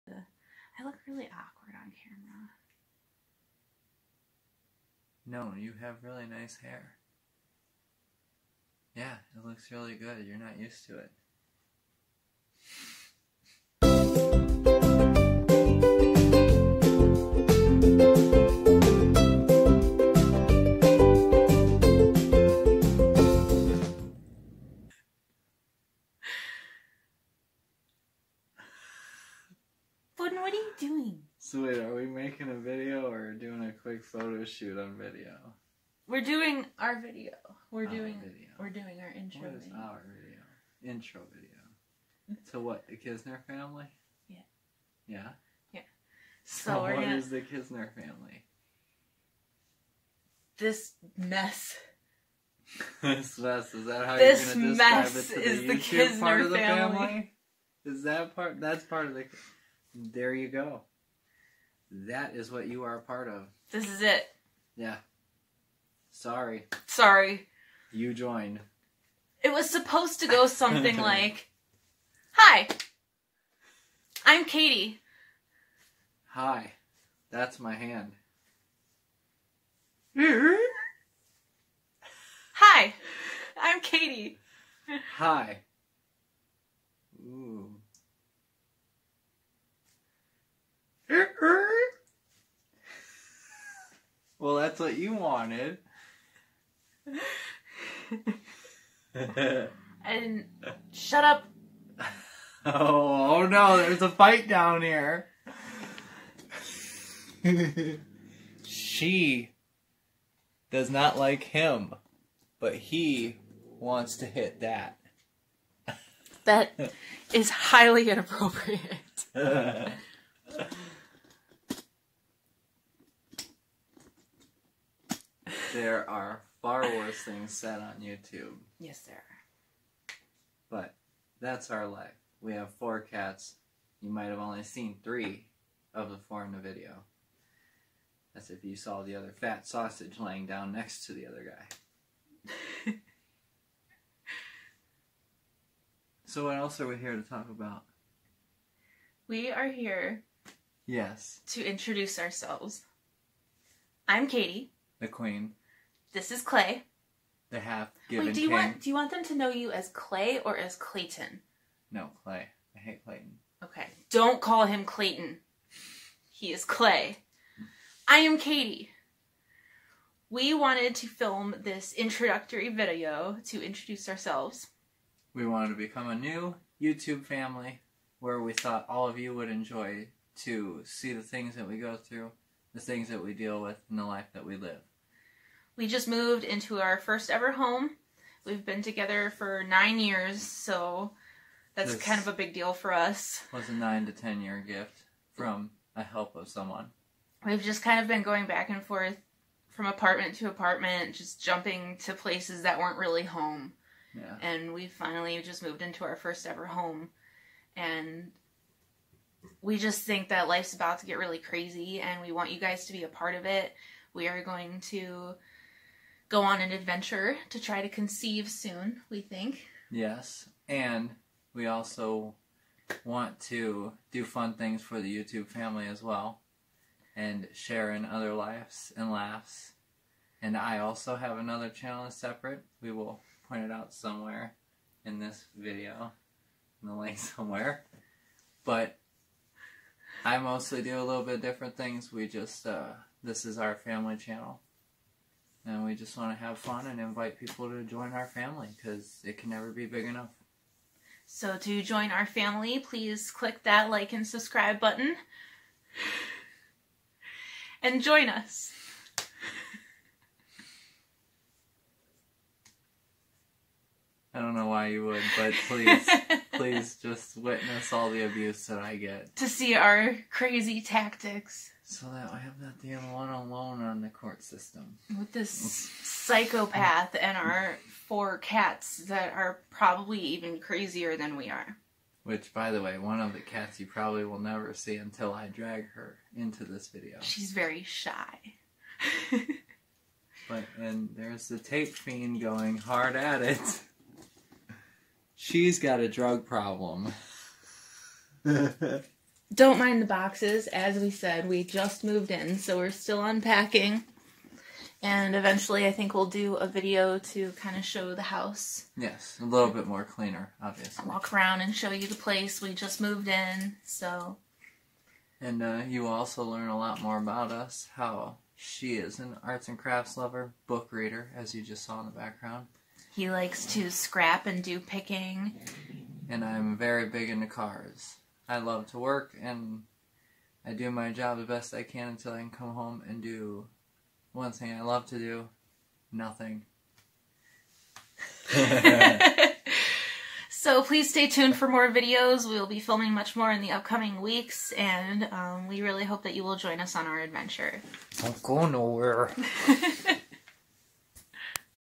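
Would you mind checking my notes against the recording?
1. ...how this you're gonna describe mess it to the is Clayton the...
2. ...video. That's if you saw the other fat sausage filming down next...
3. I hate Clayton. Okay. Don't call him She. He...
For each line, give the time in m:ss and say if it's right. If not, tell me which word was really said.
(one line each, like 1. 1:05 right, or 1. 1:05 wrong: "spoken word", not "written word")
1. 0:54 wrong: "YouTube", not "Clayton"
2. 2:16 wrong: "laying", not "filming"
3. 2:42 wrong: "Clayton", not "She".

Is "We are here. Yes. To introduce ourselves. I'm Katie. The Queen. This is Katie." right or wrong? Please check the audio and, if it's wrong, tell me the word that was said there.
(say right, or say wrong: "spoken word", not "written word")
wrong: "Clay", not "Katie".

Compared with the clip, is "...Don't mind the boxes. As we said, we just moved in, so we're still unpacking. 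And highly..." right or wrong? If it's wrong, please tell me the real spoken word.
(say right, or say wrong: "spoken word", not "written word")
wrong: "eventually", not "highly".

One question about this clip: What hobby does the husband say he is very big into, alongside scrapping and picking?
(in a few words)
Cars.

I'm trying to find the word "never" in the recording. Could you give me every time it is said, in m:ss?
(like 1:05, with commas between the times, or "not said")
4:09, 4:44.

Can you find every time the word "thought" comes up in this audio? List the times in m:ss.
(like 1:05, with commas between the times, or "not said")
2:58.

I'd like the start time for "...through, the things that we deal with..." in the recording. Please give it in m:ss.
3:01.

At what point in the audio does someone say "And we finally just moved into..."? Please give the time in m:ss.
3:24.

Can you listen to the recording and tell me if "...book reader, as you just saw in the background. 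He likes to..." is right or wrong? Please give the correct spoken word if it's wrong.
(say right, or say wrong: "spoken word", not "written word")
right.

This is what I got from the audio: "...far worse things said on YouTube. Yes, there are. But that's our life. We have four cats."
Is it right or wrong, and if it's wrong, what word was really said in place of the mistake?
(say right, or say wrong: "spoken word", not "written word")
right.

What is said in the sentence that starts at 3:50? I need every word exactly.
And I also have another channel separate.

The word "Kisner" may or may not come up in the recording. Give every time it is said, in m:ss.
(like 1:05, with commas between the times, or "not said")
0:42, 0:47, 0:55.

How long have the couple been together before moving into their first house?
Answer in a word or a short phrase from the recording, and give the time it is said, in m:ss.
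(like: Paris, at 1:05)
9 years, at 3:09.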